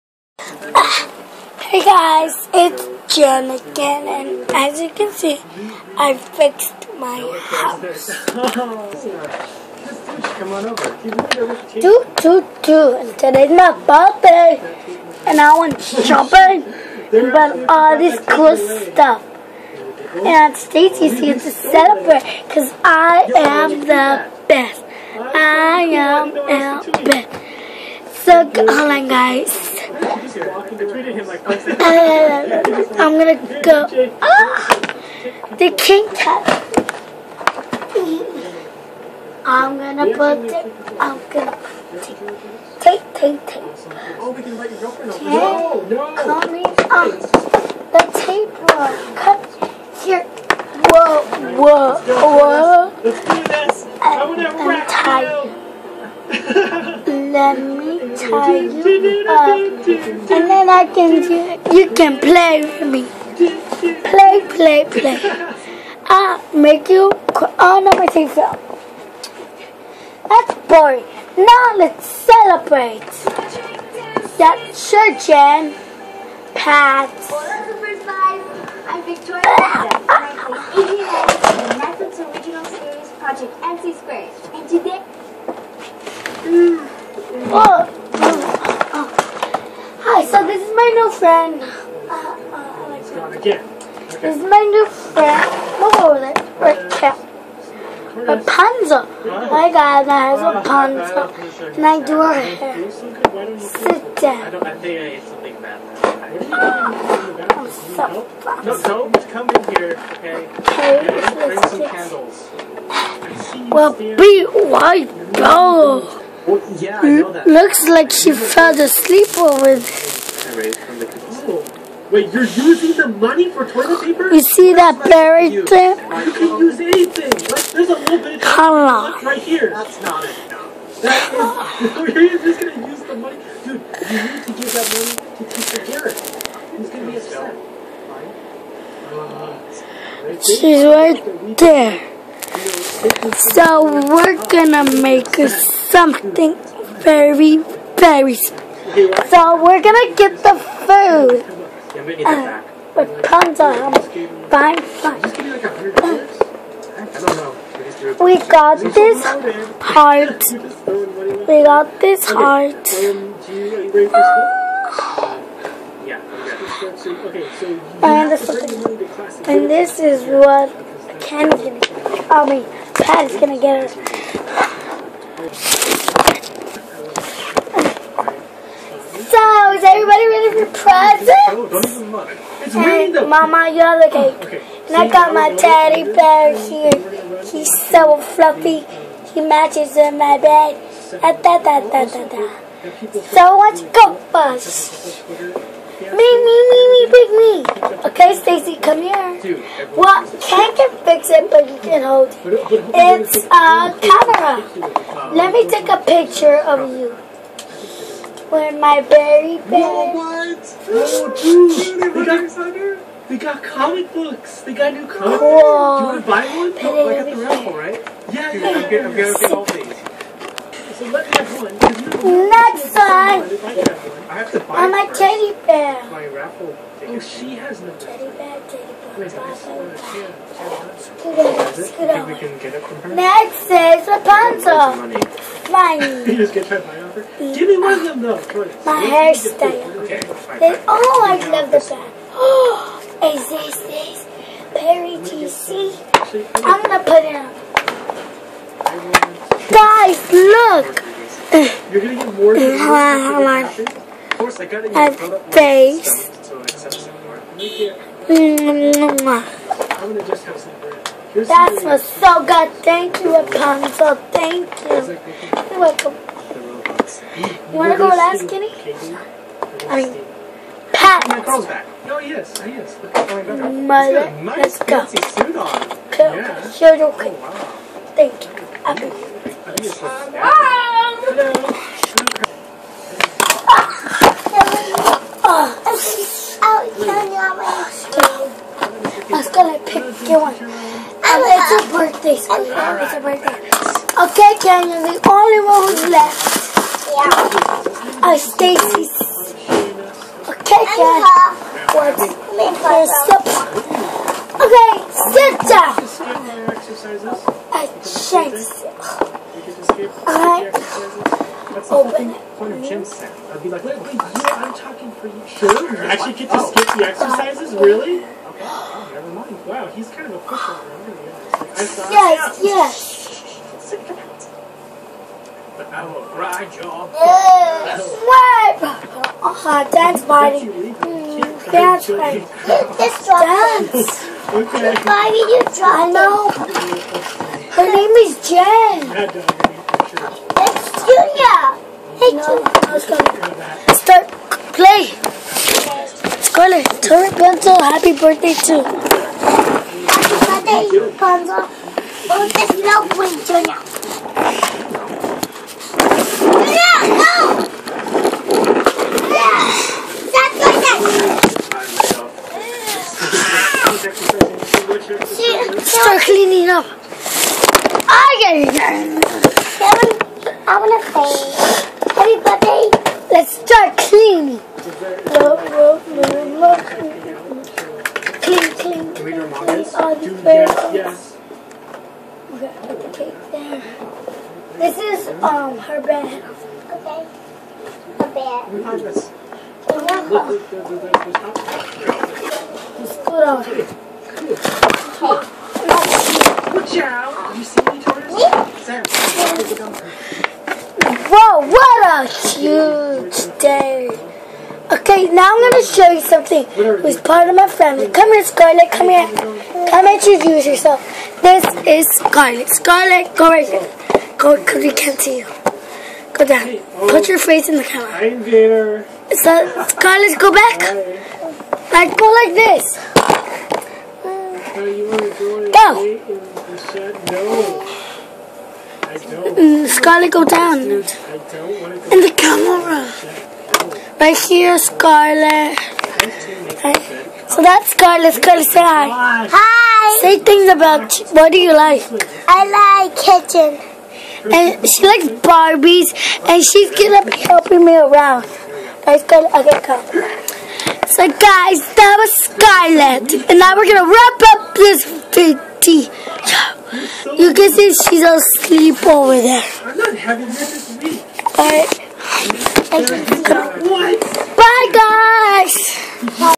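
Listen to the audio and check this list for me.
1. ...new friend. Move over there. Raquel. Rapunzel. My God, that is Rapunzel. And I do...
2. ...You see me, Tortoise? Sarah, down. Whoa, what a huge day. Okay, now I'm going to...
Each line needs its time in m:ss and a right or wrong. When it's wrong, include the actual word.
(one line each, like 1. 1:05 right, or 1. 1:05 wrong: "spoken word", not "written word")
1. 1:34 right
2. 6:37 right.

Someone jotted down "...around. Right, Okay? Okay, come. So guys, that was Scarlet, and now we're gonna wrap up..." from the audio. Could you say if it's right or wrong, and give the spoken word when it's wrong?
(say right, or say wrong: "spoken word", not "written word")
wrong: "Scarlet", not "Okay".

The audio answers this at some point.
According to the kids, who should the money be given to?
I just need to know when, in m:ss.
2:15.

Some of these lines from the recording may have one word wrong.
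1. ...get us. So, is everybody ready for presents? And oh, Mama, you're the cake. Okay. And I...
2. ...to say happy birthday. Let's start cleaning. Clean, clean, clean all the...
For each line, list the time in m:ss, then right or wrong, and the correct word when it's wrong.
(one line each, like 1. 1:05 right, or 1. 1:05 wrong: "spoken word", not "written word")
1. 2:53 right
2. 6:11 right.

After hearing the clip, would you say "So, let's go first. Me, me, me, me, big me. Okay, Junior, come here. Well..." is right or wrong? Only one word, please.
wrong.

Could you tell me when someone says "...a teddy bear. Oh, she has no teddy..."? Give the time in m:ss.
3:44.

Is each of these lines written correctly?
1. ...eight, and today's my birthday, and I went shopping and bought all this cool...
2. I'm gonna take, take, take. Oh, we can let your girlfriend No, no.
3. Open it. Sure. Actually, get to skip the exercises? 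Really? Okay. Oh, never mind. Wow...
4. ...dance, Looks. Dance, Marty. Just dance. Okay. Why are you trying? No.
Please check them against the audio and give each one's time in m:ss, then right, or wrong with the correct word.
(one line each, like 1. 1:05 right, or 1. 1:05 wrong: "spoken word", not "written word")
1. 0:12 wrong: "two", not "eight"
2. 0:40 right
3. 5:11 right
4. 5:29 wrong: "Marty", not "Looks".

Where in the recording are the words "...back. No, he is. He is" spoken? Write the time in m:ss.
4:31.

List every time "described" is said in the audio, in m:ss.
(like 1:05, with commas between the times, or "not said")
not said.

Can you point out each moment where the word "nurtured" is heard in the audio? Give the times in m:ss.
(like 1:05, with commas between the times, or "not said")
not said.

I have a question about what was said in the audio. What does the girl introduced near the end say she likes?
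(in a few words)
Kitchen.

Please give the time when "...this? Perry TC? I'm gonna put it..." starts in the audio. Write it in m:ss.
4:03.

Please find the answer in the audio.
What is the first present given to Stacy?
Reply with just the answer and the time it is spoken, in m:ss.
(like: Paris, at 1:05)
A camera, at 3:23.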